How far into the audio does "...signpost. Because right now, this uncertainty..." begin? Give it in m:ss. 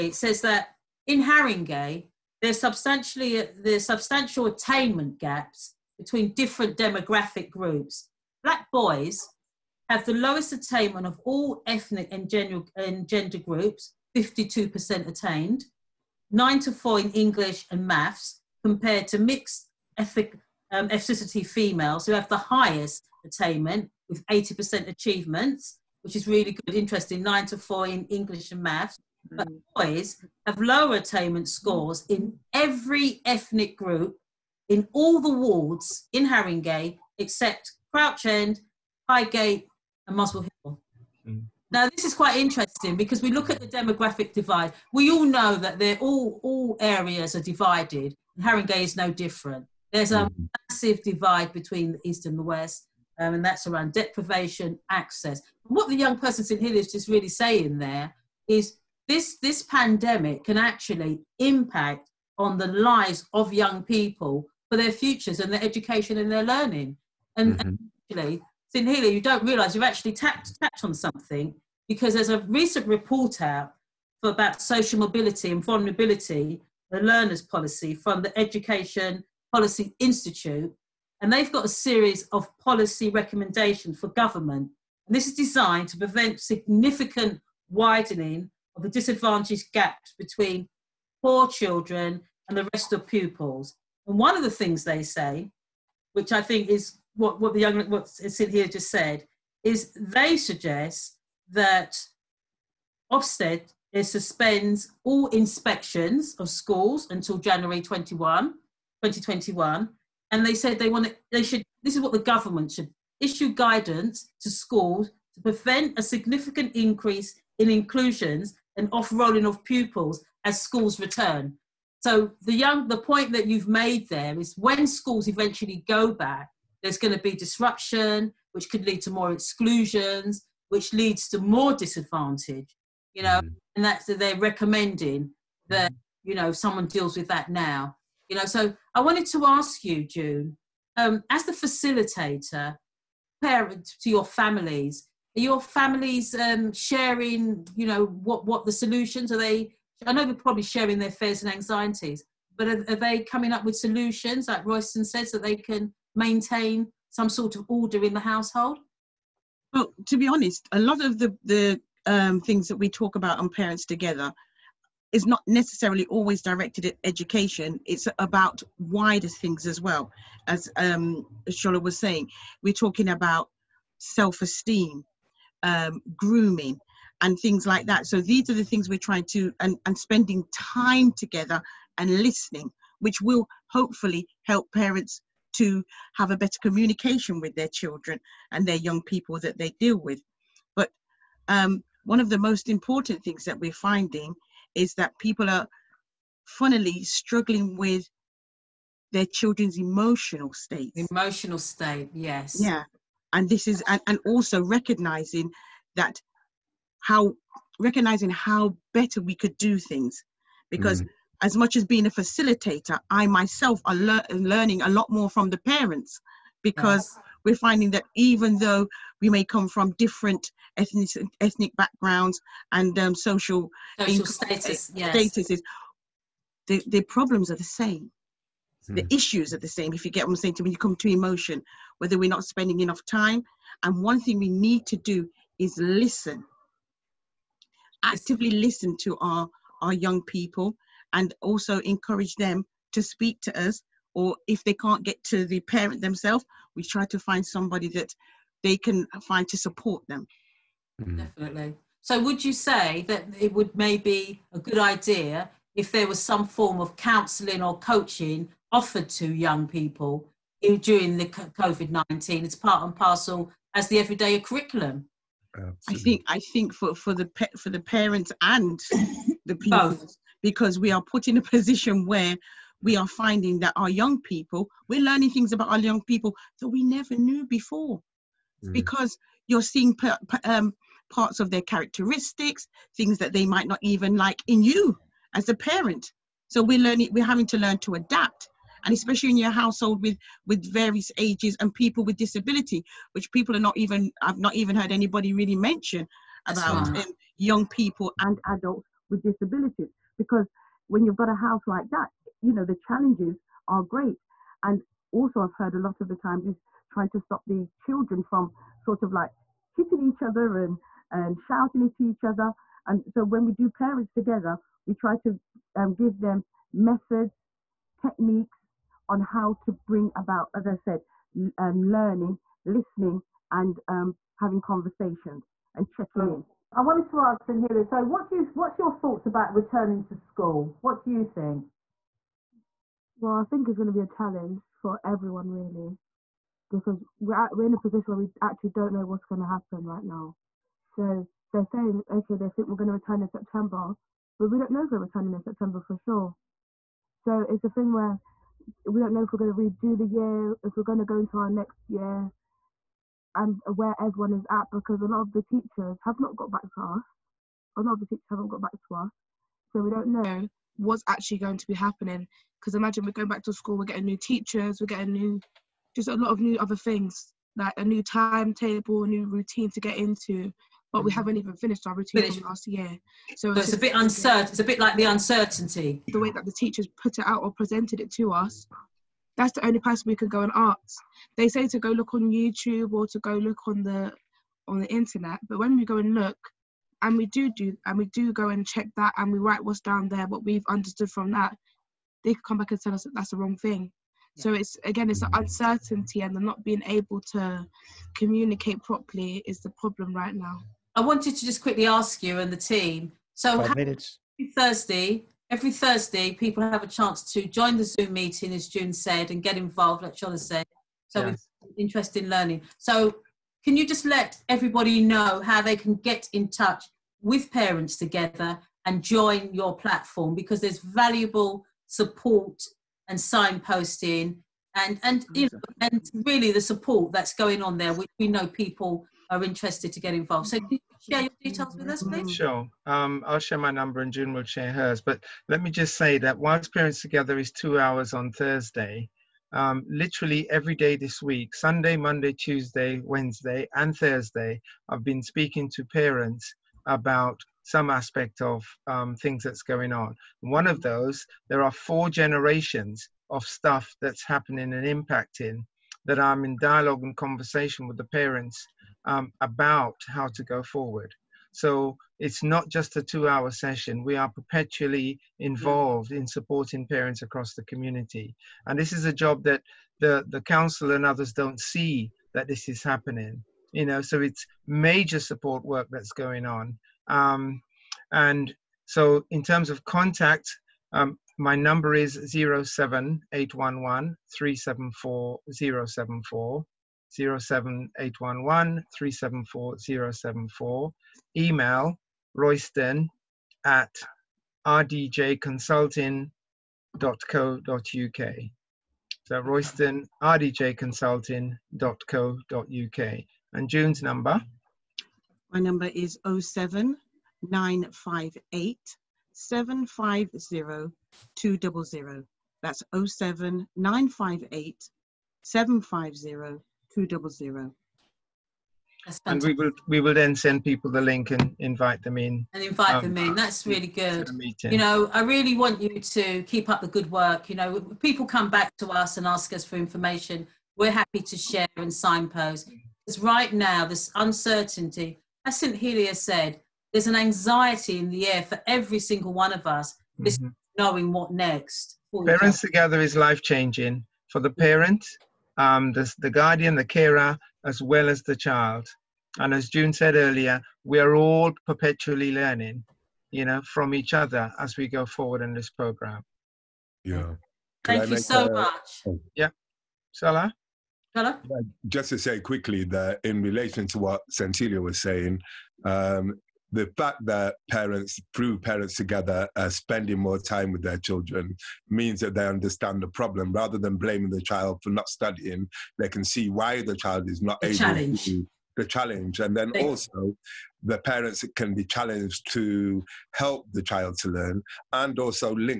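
8:51.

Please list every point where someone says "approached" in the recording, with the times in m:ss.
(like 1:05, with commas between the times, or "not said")
not said.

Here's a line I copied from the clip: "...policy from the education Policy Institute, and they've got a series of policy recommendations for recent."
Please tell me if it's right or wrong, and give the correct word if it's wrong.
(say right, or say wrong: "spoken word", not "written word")
wrong: "government", not "recent".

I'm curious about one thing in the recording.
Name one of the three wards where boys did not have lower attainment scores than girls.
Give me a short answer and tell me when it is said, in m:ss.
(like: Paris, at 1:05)
Crouch End, at 0:37.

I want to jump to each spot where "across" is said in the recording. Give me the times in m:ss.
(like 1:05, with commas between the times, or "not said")
7:47.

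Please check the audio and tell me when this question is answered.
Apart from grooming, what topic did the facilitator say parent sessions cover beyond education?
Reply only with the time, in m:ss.
2:53.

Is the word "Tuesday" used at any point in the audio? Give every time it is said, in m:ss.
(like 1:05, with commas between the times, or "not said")
7:22.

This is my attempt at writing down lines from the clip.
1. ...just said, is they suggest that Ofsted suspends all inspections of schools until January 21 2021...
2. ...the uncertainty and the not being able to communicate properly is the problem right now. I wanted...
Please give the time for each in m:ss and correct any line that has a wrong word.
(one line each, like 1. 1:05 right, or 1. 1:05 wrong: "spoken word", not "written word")
1. 1:38 right
2. 6:35 right.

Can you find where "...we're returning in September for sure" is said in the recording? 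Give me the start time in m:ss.
5:44.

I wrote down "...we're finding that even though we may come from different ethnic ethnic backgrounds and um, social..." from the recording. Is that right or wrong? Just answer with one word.
right.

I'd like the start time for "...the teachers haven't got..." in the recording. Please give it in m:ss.
5:57.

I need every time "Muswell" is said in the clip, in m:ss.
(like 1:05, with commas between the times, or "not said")
0:40.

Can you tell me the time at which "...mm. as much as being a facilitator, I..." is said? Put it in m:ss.
3:31.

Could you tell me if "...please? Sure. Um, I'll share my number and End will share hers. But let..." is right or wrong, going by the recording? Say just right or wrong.
wrong.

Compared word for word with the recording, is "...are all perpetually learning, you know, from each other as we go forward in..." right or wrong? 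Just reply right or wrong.
right.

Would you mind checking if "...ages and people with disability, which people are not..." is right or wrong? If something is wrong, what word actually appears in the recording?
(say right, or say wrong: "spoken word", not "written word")
right.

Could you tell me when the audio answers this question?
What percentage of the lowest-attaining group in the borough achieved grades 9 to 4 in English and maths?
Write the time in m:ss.
0:14.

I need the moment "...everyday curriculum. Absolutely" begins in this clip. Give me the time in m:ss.
4:23.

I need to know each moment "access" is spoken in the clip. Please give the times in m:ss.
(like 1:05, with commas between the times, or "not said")
0:54.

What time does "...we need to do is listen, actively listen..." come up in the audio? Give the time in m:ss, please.
3:54.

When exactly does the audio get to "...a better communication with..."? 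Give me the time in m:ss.
3:06.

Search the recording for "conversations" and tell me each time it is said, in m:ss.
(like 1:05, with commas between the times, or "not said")
5:24, 7:37.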